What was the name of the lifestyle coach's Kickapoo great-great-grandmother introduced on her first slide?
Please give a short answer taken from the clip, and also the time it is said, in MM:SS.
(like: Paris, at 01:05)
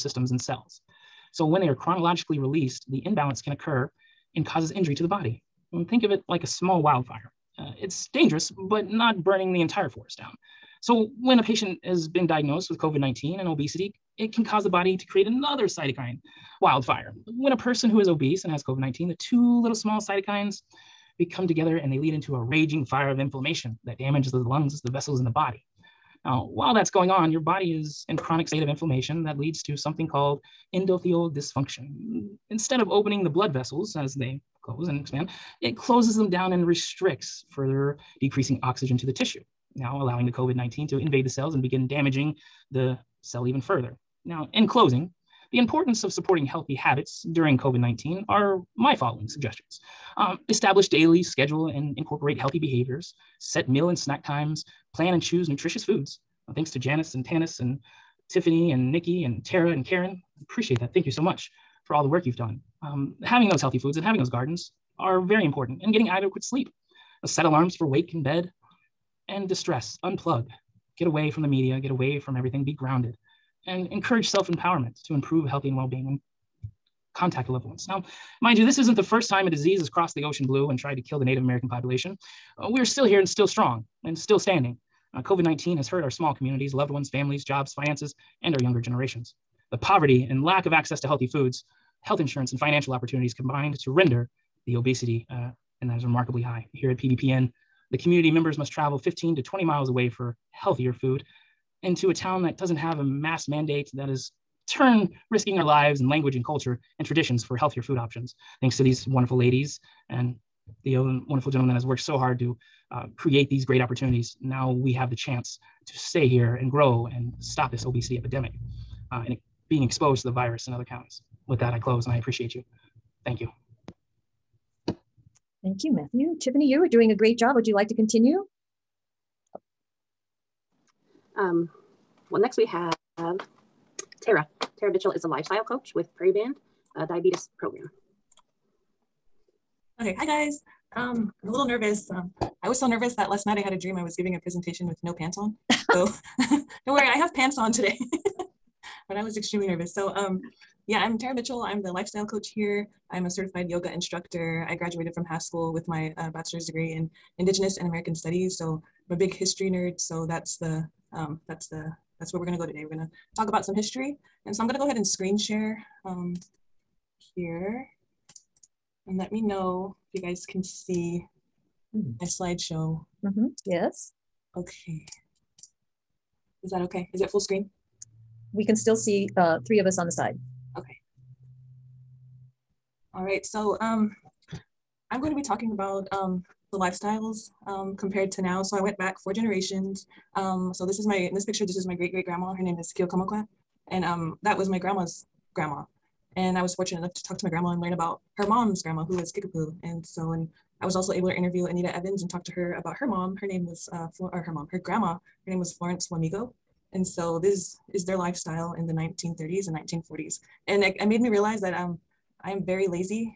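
Kiyokamokwa, at 03:12.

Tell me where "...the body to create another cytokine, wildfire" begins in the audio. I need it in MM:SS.
00:14.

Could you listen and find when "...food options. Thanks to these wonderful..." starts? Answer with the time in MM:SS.
01:47.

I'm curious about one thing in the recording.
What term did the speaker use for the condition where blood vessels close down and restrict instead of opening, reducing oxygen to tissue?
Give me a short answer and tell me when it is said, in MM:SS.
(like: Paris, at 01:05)
endothelial dysfunction, at 00:30.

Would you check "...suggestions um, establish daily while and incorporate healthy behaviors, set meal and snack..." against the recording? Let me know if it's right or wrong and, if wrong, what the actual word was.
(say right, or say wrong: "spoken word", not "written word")
wrong: "schedule", not "while".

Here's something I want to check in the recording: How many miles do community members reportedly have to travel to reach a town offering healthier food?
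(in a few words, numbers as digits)
15 to 20 miles.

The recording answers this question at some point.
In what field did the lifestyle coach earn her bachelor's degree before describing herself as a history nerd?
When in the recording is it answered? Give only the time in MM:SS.
02:37.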